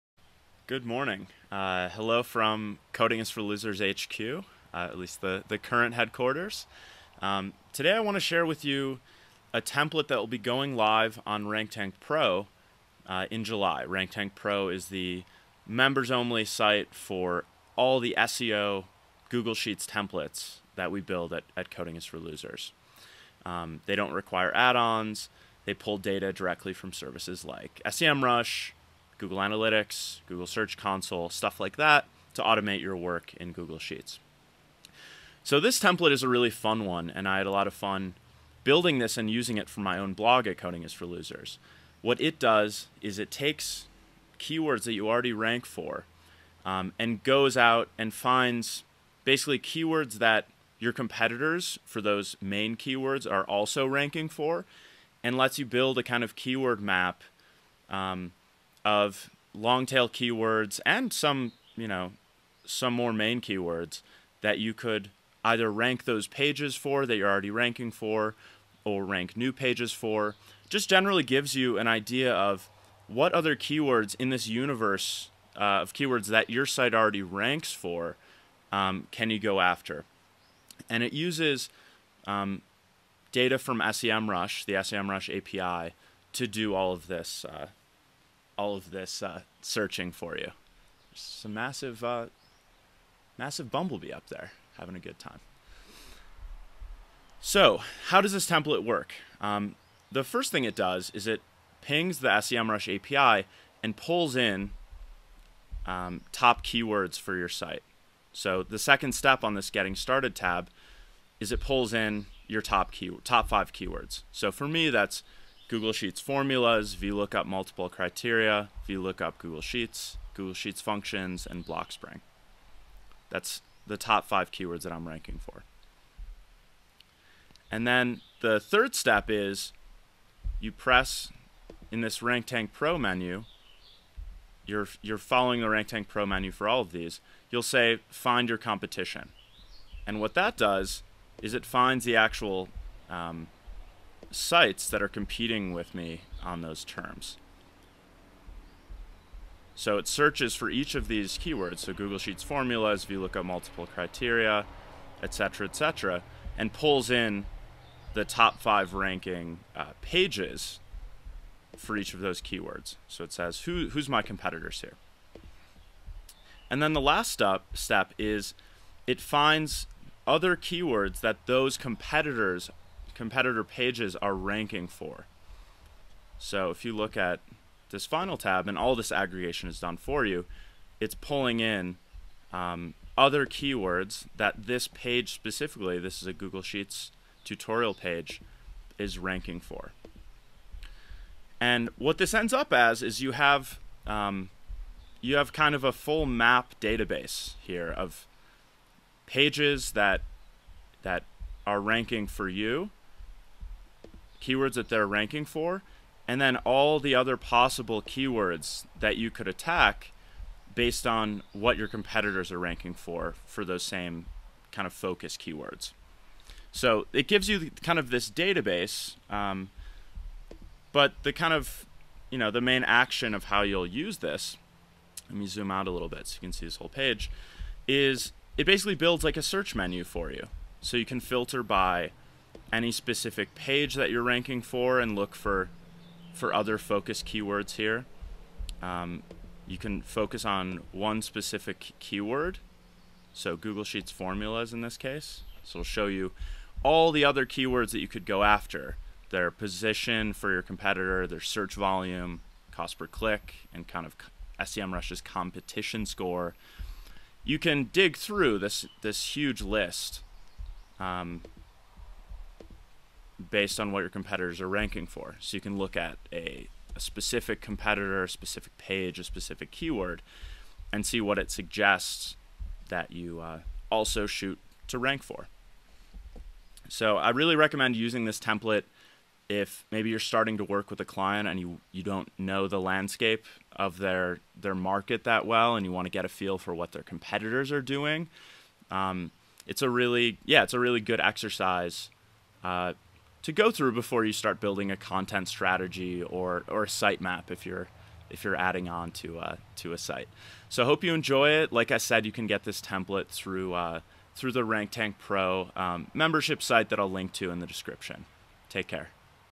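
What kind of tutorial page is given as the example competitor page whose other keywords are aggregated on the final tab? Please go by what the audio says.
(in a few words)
Google Sheets tutorial.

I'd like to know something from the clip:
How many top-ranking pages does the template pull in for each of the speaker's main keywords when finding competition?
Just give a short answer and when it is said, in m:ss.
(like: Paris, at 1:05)
5, at 2:38.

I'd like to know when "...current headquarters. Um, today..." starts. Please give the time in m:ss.
0:05.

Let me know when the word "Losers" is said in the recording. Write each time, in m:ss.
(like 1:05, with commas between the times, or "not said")
0:03, 0:22, 0:41.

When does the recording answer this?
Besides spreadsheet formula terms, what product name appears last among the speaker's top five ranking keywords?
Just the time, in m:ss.
2:01.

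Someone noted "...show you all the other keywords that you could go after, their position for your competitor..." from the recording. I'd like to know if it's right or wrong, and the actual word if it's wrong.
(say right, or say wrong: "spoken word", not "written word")
right.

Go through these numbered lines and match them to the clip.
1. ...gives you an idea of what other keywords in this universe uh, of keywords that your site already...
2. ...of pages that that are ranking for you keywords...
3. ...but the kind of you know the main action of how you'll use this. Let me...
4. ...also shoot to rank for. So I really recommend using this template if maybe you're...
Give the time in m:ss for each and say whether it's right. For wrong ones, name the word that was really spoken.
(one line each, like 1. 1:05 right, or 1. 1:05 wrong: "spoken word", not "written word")
1. 1:11 right
2. 3:17 right
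3. 3:40 right
4. 4:33 right.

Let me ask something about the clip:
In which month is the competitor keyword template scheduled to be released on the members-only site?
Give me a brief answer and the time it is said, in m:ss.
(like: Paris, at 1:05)
July, at 0:13.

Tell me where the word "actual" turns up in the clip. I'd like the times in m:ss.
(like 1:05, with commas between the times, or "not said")
2:22.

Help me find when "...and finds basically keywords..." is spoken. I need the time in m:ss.
0:47.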